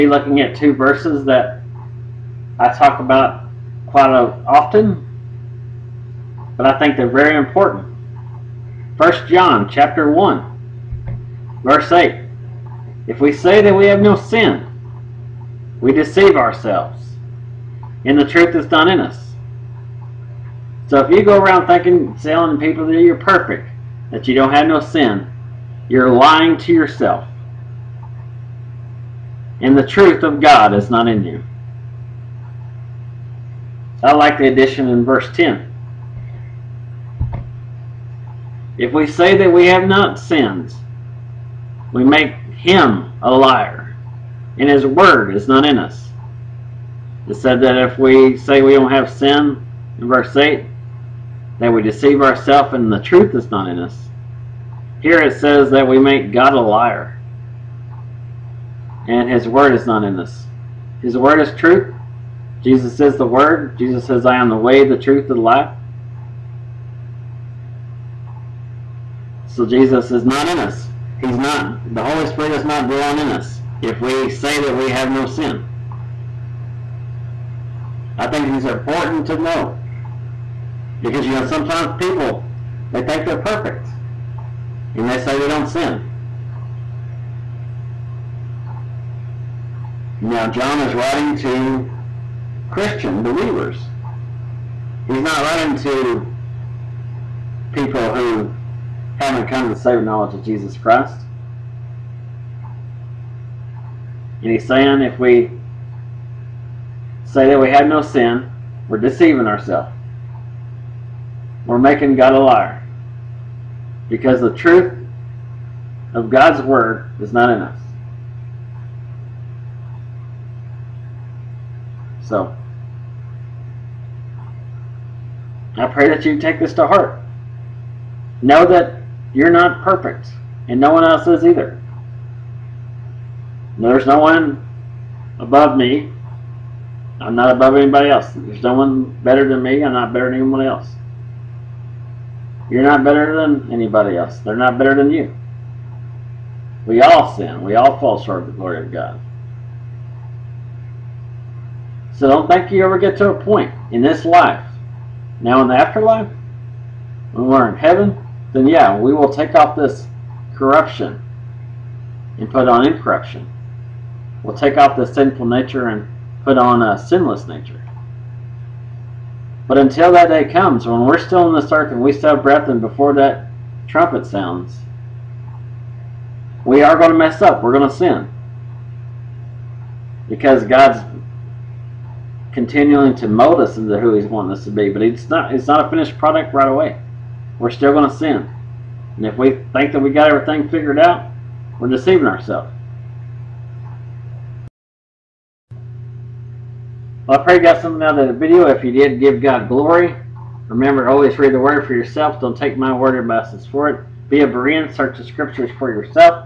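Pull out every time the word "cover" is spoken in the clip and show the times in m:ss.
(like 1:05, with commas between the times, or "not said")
not said.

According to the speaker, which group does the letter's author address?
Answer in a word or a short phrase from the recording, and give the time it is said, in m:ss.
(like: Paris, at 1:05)
Christian believers, at 1:32.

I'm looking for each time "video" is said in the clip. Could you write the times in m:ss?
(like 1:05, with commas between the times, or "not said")
3:18.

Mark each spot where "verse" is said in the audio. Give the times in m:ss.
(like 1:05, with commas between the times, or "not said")
0:00, 0:11, 0:35, 0:50.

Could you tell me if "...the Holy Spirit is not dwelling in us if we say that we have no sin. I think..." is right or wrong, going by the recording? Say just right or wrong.
right.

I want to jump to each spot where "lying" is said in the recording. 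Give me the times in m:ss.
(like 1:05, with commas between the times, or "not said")
0:26.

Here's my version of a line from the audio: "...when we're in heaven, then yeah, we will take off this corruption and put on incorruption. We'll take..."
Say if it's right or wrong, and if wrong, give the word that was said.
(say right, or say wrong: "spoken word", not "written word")
right.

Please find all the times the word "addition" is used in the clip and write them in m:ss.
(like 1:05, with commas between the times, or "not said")
0:34.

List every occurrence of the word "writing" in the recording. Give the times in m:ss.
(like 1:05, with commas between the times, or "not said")
1:30, 1:35.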